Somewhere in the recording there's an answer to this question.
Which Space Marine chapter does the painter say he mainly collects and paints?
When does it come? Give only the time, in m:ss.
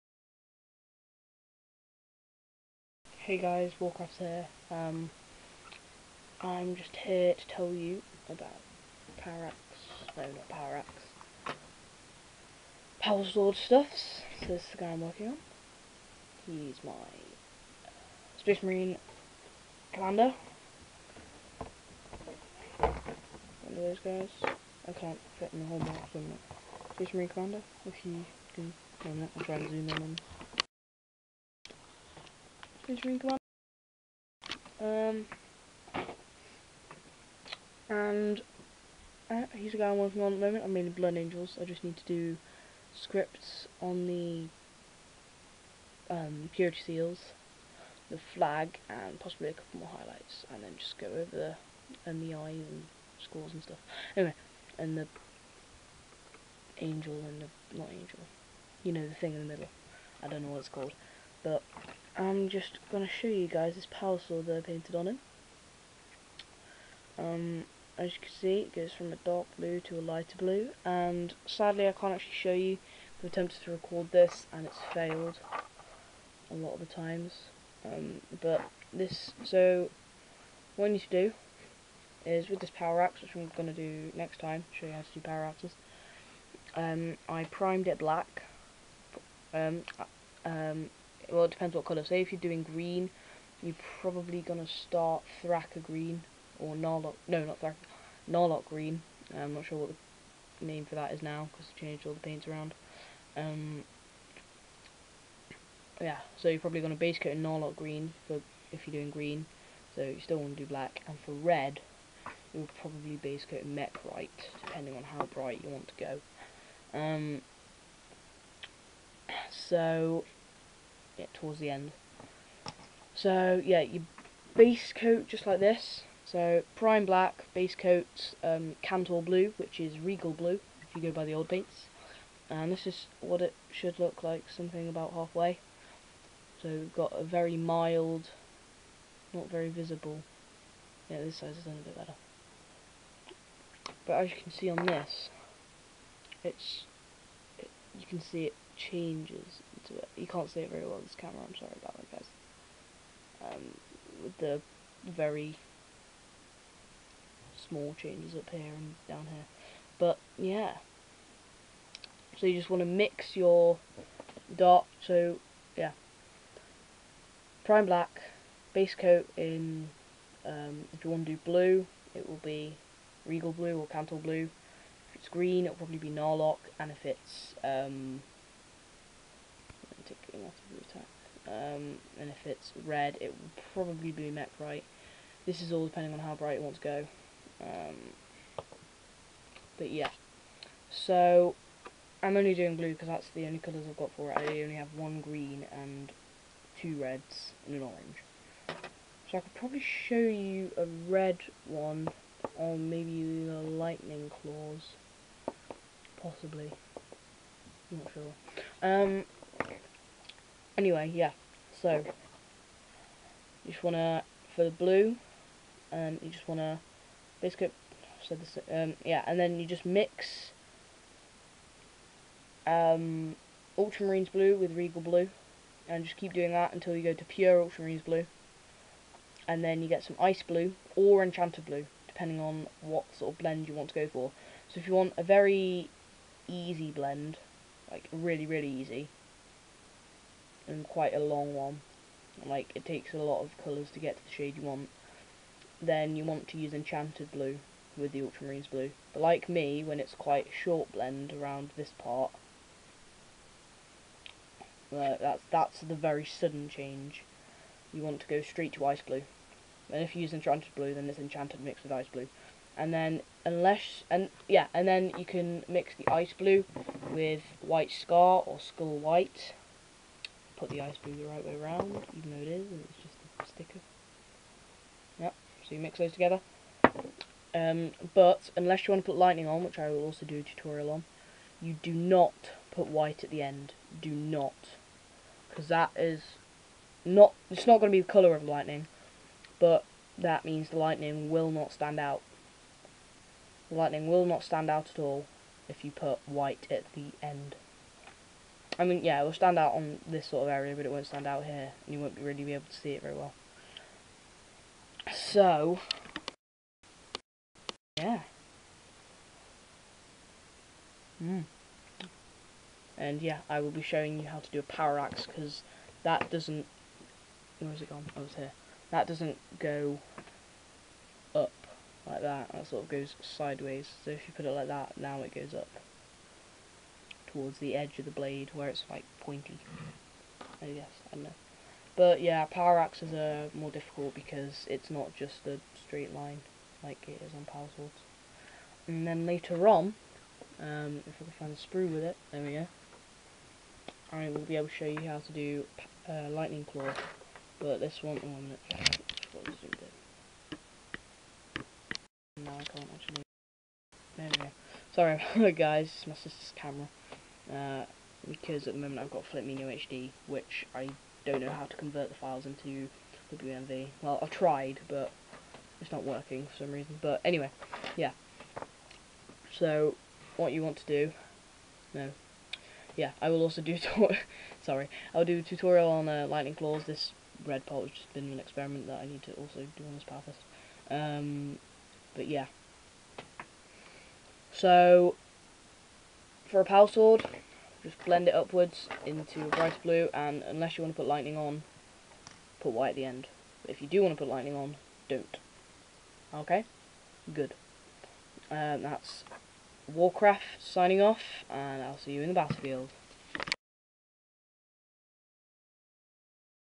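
0:40.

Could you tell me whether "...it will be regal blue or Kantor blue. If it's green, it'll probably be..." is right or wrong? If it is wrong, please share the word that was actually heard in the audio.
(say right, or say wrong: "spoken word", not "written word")
right.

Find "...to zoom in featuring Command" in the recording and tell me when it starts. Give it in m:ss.
0:29.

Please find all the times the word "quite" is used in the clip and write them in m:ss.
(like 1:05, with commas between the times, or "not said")
4:00, 4:10.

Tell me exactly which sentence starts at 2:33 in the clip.
Um, with the very small changes up here and down here.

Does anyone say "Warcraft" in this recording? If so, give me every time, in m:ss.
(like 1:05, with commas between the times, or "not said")
0:03, 6:39.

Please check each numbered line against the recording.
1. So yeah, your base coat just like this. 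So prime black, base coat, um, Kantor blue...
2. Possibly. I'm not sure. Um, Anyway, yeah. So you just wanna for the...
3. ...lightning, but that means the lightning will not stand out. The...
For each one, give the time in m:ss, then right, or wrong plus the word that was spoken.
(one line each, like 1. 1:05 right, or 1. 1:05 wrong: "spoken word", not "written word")
1. 2:03 right
2. 3:26 right
3. 4:48 right.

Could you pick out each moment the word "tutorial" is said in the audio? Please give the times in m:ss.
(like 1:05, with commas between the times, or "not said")
4:40, 6:15.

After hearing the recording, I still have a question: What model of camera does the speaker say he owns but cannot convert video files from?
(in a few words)
Flip Mino HD.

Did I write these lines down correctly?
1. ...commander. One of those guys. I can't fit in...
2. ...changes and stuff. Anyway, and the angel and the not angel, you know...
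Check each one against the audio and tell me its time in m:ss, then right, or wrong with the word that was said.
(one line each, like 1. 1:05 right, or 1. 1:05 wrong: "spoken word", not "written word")
1. 0:19 right
2. 0:53 wrong: "scores", not "changes".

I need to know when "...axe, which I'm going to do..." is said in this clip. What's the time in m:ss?
1:23.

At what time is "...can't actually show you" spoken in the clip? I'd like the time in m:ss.
1:11.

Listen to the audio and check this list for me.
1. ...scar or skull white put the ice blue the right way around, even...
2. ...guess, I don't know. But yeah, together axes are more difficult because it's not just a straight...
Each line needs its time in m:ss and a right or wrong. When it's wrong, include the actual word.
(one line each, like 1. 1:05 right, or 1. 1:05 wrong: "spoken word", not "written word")
1. 4:27 right
2. 5:30 wrong: "power", not "together".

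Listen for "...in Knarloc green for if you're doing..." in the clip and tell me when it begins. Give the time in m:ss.
1:47.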